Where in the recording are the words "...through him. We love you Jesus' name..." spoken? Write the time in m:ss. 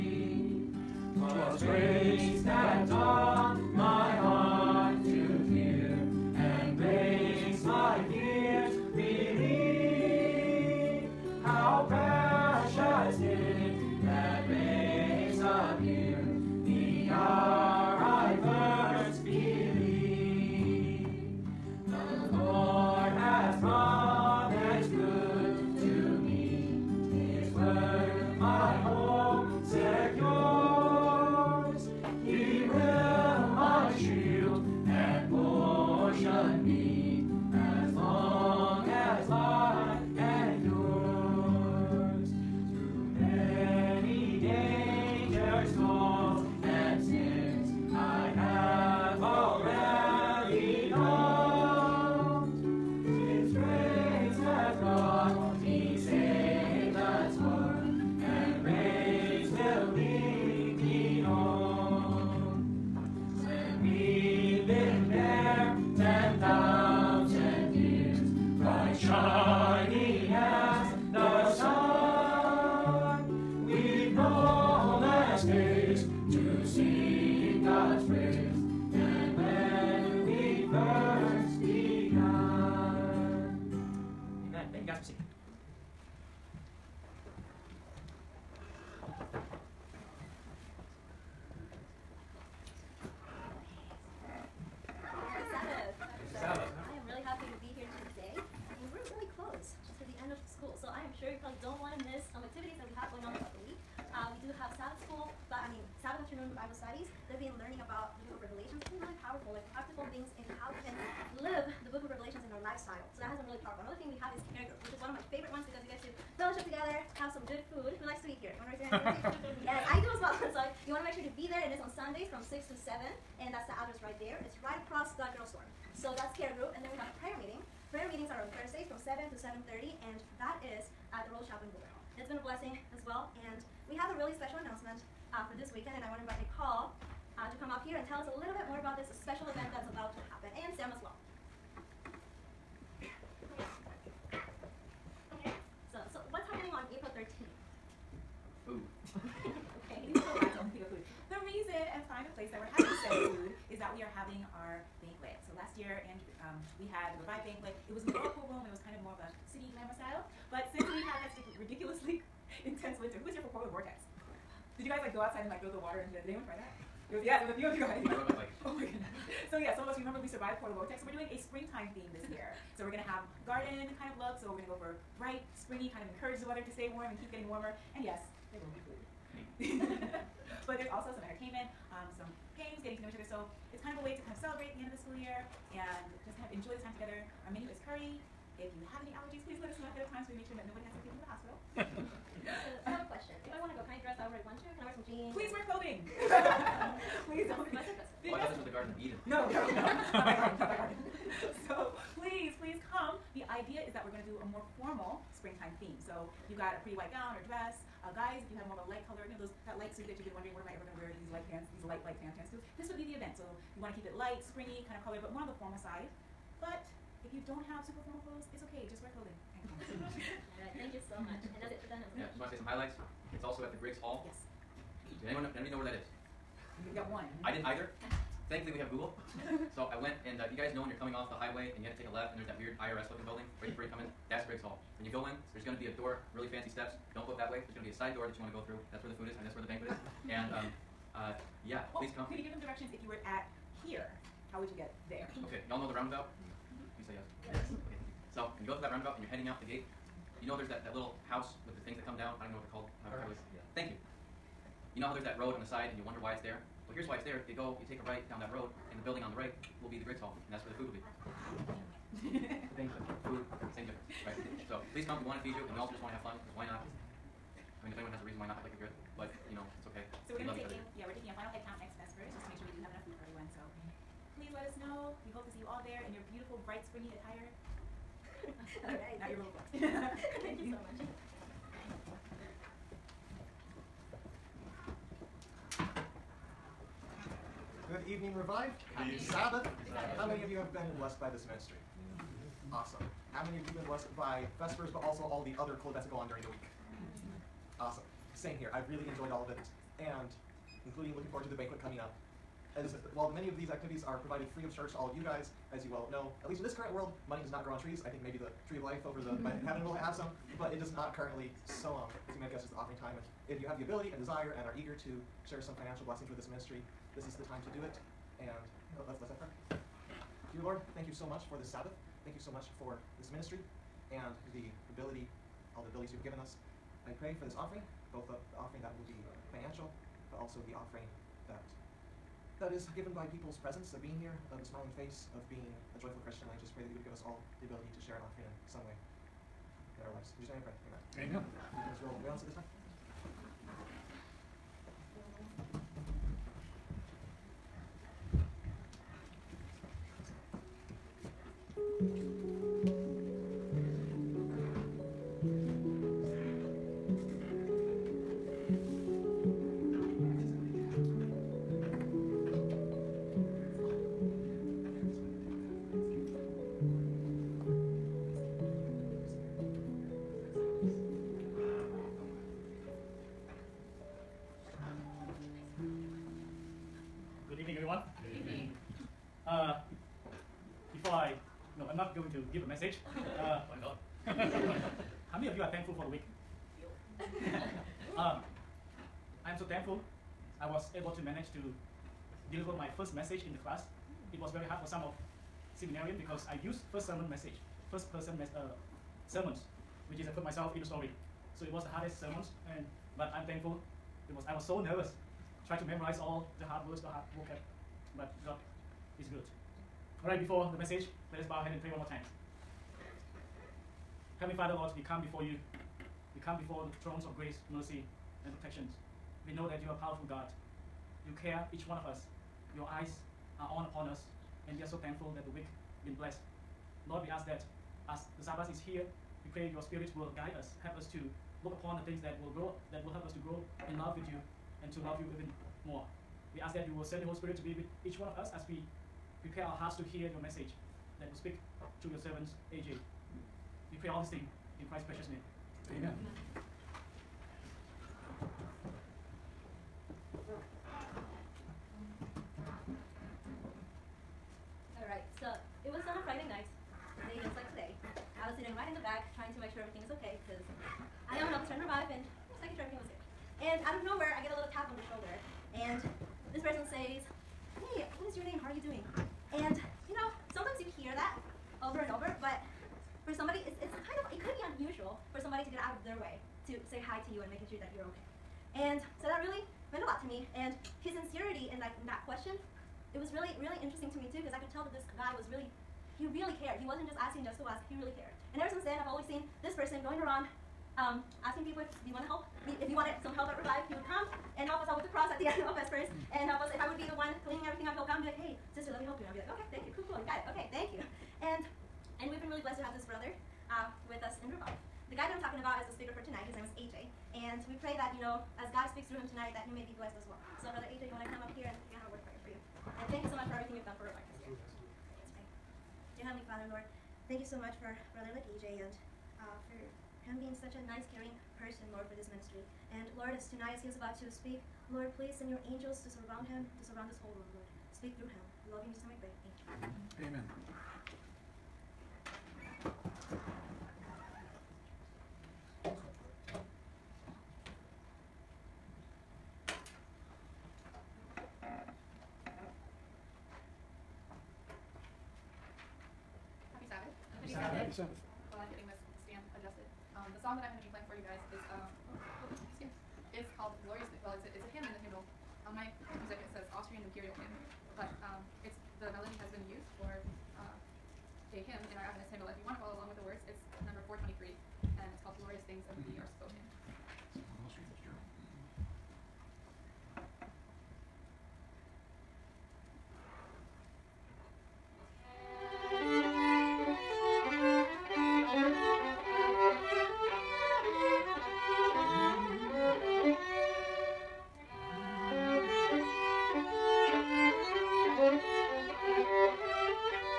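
8:48.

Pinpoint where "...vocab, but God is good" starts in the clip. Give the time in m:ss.
6:47.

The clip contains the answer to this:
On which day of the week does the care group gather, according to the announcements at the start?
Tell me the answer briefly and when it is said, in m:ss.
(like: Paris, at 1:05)
Sundays, at 2:01.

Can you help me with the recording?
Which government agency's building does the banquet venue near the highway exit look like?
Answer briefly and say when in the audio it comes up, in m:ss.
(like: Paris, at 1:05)
IRS, at 3:52.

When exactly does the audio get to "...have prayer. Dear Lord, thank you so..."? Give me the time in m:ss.
5:19.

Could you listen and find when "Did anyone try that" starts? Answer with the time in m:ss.
2:46.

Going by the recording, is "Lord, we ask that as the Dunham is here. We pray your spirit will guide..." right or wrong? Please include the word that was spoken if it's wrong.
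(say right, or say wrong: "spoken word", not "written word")
wrong: "Sabbath", not "Dunham".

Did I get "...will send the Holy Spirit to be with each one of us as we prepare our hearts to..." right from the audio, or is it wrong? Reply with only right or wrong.
right.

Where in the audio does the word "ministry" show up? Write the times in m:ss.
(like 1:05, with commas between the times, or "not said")
4:51, 5:16, 5:23, 8:42.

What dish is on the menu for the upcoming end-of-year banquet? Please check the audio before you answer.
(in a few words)
Curry.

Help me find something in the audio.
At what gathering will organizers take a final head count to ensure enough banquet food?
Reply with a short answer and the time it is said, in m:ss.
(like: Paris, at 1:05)
Next Vespers, at 4:31.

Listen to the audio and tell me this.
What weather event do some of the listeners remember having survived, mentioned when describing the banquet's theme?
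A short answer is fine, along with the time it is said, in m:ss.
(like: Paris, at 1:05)
Polar Vortex, at 2:50.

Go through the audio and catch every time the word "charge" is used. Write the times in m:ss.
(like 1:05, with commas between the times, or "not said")
5:04.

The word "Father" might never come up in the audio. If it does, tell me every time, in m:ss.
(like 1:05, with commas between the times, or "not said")
6:54, 8:36.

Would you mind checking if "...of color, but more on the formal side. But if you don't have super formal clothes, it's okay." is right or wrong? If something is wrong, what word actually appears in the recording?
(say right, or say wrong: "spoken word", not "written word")
right.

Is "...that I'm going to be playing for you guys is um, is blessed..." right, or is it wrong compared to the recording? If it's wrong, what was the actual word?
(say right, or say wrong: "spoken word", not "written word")
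wrong: "called", not "blessed".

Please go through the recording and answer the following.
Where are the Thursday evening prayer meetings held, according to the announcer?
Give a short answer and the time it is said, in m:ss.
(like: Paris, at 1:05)
the Rose Shop in Boulder, at 2:11.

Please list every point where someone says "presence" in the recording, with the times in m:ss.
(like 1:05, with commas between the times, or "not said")
5:33.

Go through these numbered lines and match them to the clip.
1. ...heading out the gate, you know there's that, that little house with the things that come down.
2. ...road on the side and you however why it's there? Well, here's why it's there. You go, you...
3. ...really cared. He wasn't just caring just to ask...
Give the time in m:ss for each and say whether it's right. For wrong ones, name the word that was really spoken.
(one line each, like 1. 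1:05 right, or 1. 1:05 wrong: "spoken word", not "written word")
1. 4:09 right
2. 4:15 wrong: "wonder", not "however"
3. 8:06 wrong: "asking", not "caring".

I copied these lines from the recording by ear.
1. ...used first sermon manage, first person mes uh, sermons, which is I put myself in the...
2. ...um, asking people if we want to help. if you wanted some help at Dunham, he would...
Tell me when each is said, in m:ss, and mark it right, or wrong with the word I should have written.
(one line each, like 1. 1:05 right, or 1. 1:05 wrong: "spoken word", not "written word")
1. 6:36 wrong: "message", not "manage"
2. 8:10 wrong: "Revive", not "Dunham".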